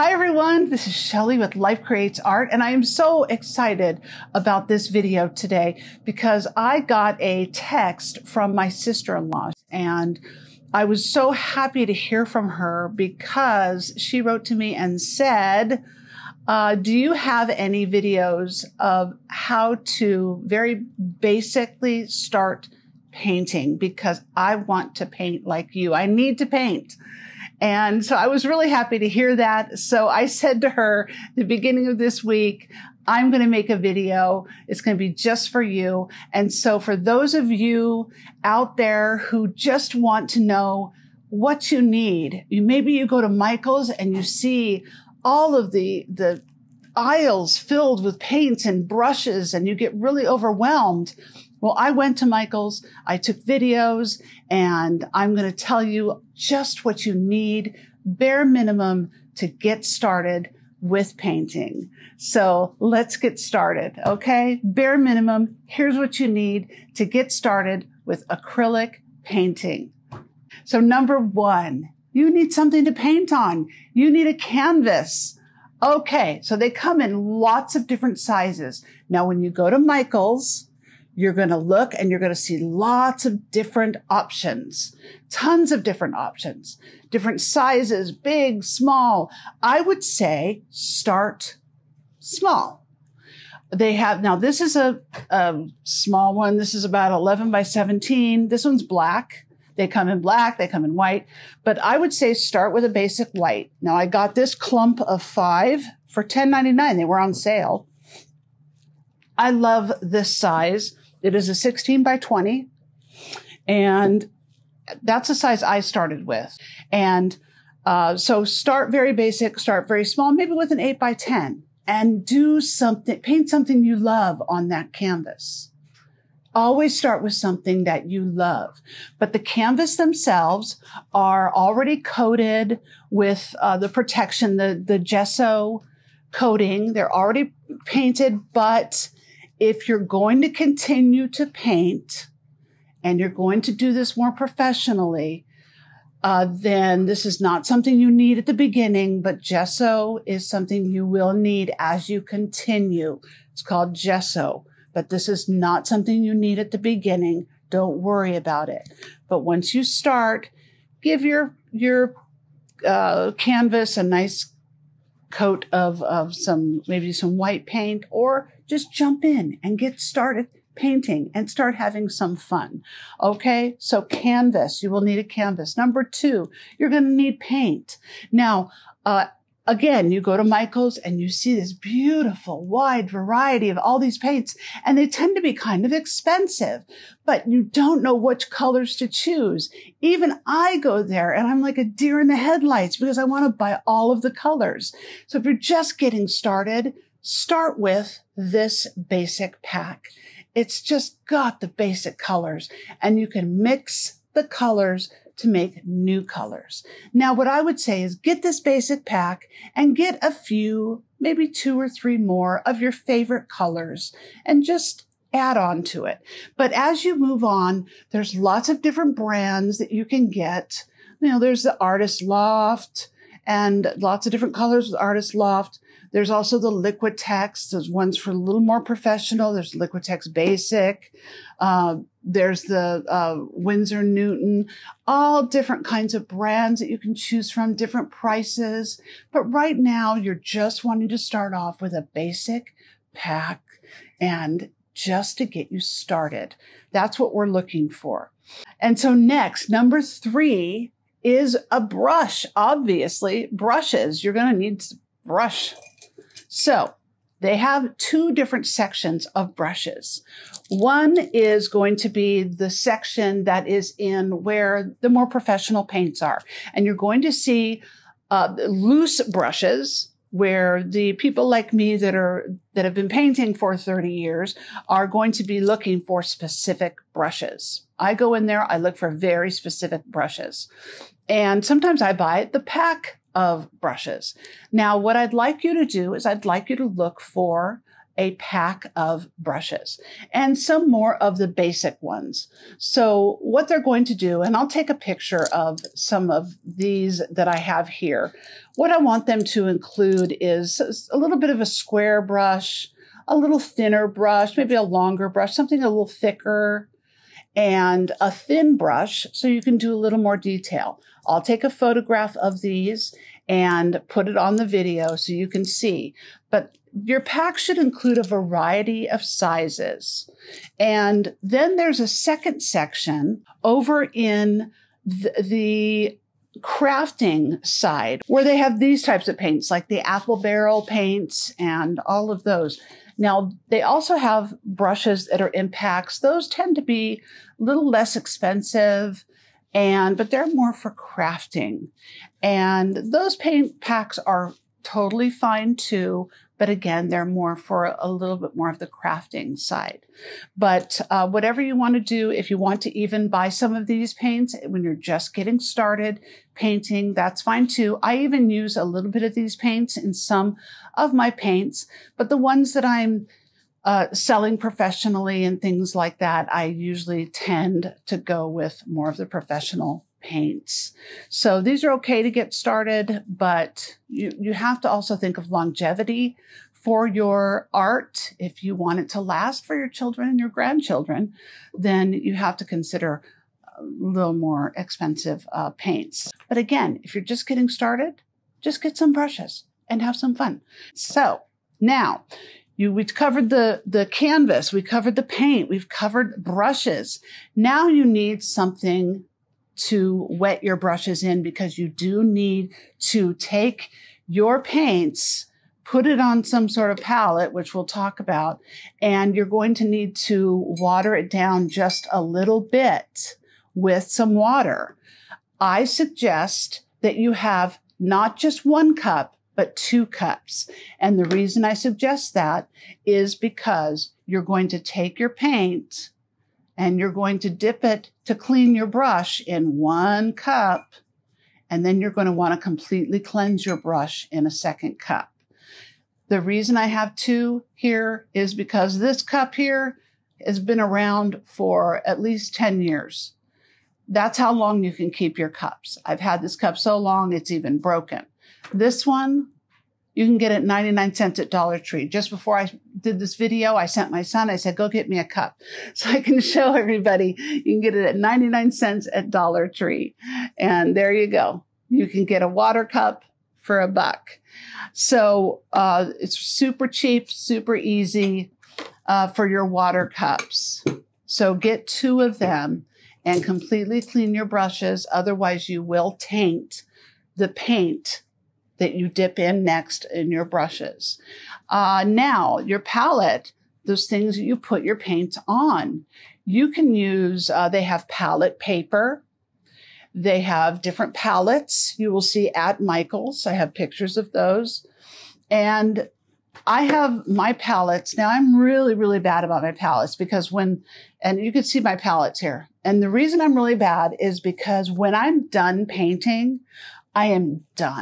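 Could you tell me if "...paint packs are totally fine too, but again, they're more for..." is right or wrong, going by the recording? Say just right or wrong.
right.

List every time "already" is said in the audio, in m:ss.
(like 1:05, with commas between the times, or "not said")
2:11, 2:17.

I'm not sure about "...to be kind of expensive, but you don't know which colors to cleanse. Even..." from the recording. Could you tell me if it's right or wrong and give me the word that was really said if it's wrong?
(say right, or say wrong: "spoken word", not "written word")
wrong: "choose", not "cleanse".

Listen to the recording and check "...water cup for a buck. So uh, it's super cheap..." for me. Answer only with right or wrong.
right.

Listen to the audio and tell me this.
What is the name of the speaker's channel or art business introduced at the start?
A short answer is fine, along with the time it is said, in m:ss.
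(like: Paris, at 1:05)
Life Creates Art, at 0:01.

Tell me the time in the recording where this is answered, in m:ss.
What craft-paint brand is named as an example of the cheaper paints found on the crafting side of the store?
5:30.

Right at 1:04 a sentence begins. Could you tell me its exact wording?
Bare minimum, here's what you need to get started with acrylic painting.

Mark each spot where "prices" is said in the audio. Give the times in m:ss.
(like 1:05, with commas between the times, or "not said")
3:58.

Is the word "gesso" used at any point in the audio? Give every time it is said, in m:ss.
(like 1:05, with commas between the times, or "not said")
2:14, 2:29, 2:33.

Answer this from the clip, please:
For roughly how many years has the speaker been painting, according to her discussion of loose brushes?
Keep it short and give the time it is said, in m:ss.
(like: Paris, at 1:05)
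30 years, at 4:33.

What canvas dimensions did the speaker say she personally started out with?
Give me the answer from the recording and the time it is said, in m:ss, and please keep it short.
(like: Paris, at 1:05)
16 by 20, at 1:51.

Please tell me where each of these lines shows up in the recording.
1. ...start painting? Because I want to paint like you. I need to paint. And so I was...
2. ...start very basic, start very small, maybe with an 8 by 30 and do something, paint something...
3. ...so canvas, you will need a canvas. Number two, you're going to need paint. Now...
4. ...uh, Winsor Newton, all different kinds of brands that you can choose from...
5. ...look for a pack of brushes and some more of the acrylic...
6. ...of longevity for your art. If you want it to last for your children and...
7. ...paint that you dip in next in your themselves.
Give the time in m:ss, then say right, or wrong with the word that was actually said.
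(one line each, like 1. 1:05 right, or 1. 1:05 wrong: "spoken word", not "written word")
1. 0:22 right
2. 1:58 wrong: "10", not "30"
3. 2:53 right
4. 3:53 right
5. 4:46 wrong: "basic", not "acrylic"
6. 6:15 right
7. 7:57 wrong: "brushes", not "themselves".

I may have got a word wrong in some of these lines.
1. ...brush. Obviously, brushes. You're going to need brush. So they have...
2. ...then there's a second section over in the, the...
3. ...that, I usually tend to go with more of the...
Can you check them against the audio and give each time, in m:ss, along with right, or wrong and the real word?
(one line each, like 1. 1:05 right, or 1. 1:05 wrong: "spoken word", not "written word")
1. 4:11 right
2. 5:21 right
3. 6:06 right.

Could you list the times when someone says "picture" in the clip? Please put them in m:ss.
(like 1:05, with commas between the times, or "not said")
4:54, 8:13.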